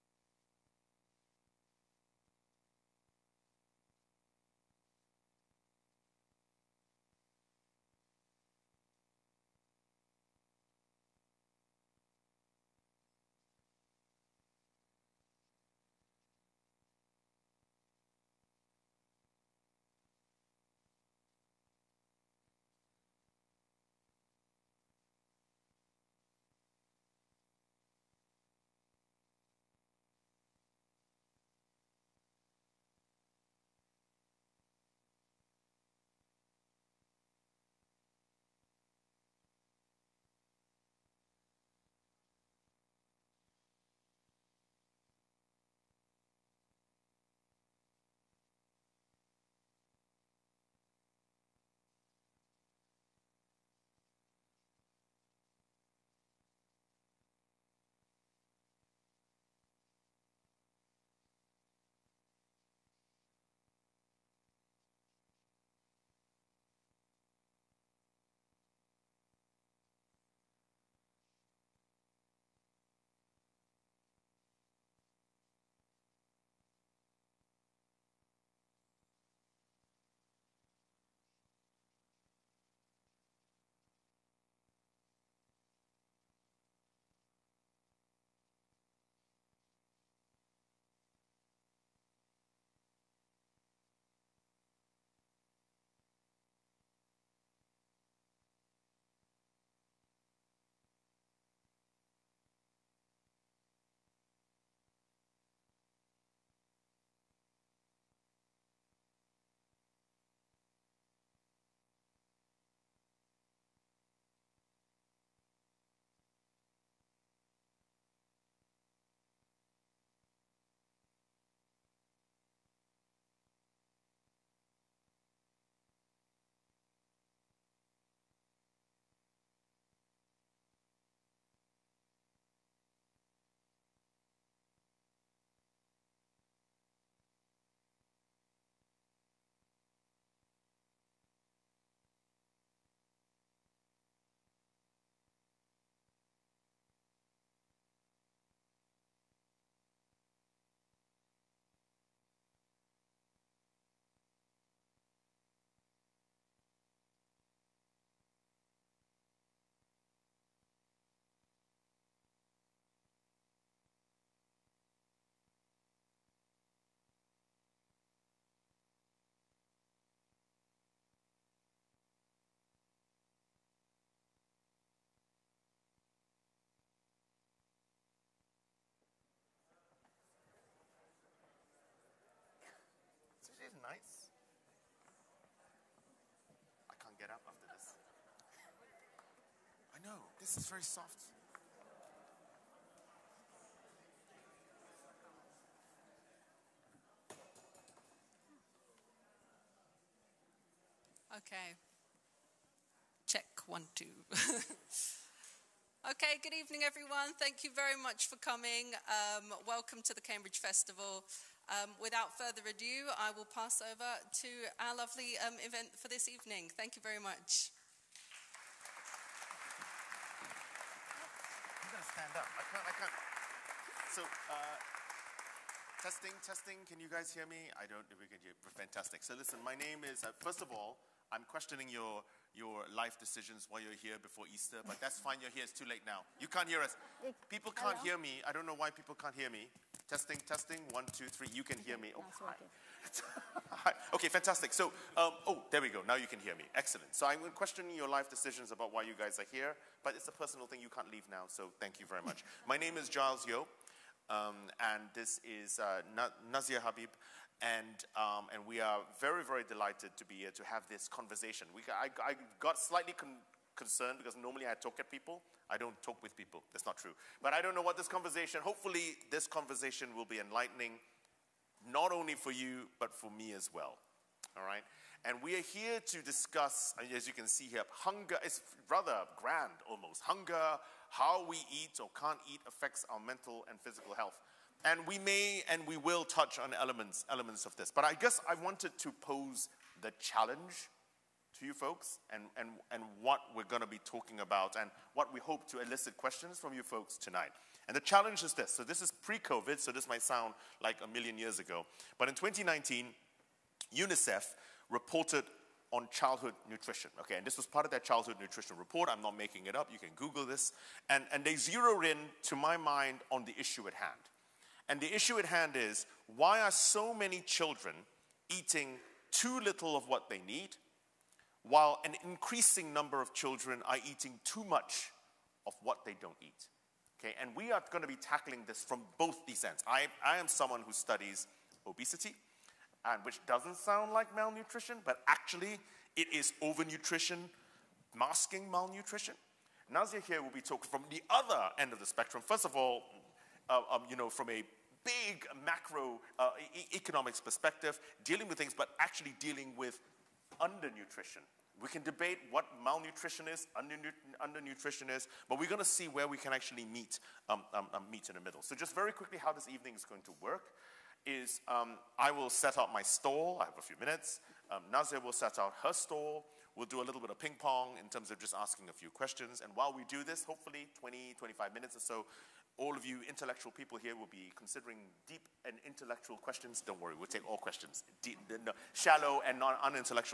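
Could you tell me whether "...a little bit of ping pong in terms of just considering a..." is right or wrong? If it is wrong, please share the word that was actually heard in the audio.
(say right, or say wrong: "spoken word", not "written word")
wrong: "asking", not "considering".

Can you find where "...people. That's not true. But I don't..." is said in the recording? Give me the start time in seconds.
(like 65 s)
266 s.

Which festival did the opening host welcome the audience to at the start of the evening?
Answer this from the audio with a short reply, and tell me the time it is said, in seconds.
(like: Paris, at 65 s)
Cambridge Festival, at 210 s.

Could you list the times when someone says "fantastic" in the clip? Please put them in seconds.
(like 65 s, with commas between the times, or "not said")
228 s, 244 s.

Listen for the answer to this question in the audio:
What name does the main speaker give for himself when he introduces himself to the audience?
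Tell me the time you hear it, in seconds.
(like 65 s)
253 s.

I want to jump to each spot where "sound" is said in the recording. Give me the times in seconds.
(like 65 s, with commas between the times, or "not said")
300 s, 333 s.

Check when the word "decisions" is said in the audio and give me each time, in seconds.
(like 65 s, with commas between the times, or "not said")
233 s, 248 s.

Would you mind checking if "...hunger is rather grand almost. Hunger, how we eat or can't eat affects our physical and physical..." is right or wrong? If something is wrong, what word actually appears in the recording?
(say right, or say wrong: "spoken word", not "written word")
wrong: "mental", not "physical".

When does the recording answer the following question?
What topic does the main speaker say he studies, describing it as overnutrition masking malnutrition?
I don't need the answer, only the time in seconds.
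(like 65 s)
331 s.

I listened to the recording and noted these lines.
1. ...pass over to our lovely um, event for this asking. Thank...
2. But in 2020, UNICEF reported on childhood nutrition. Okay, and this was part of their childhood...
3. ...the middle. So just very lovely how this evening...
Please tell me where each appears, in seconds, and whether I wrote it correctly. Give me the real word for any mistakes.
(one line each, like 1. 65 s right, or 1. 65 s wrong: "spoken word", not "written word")
1. 213 s wrong: "evening", not "asking"
2. 302 s wrong: "2019", not "2020"
3. 358 s wrong: "quickly", not "lovely".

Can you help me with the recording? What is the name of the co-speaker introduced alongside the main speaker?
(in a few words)
Nazia Habib.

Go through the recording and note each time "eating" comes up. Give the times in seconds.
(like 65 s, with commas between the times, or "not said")
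318 s, 324 s.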